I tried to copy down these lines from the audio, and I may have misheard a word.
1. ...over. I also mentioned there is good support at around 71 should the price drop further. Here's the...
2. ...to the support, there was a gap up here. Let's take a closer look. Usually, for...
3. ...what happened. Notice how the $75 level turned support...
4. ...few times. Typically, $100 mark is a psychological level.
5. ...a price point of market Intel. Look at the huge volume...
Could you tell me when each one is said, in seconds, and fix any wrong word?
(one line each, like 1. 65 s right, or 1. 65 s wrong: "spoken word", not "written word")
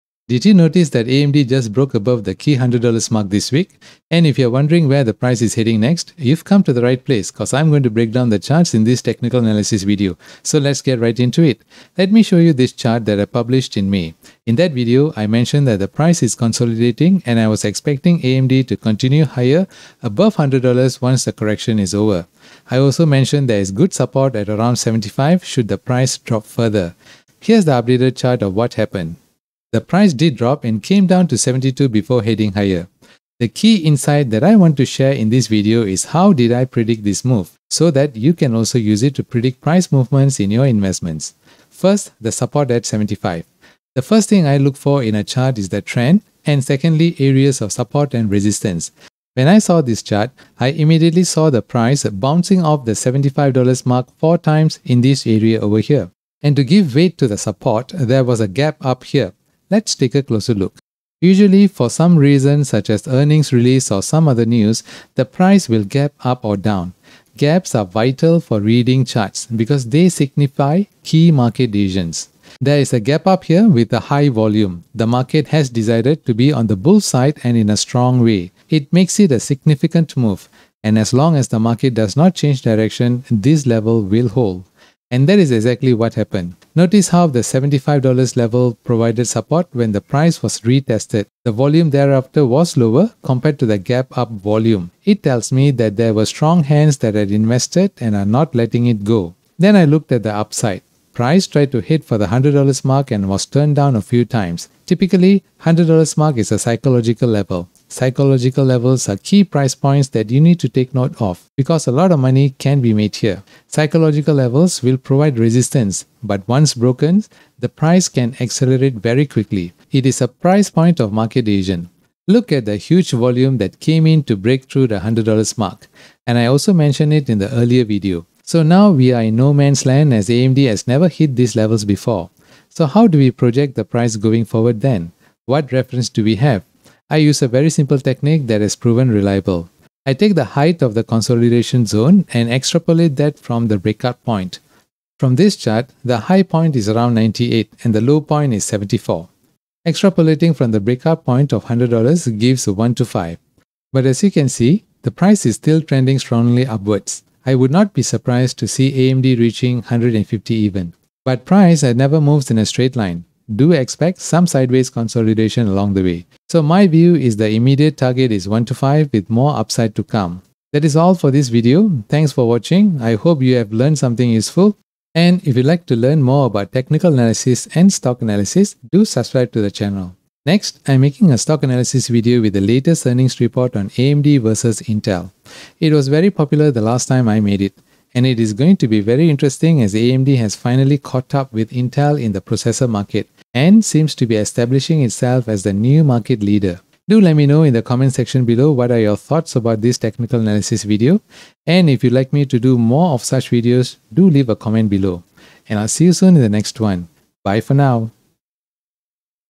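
1. 21 s wrong: "75", not "71"
2. 57 s right
3. 85 s wrong: "provided", not "turned"
4. 104 s right
5. 120 s wrong: "Asian", not "Intel".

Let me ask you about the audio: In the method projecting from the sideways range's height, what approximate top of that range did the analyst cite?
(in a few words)
$98.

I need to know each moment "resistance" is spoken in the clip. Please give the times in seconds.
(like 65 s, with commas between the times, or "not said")
48 s, 115 s.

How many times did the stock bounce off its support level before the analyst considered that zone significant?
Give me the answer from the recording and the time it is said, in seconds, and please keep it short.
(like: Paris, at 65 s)
four times, at 54 s.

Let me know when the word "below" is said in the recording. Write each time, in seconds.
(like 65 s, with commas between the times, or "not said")
198 s, 204 s.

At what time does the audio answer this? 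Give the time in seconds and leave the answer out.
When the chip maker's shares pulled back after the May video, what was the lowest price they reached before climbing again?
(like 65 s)
31 s.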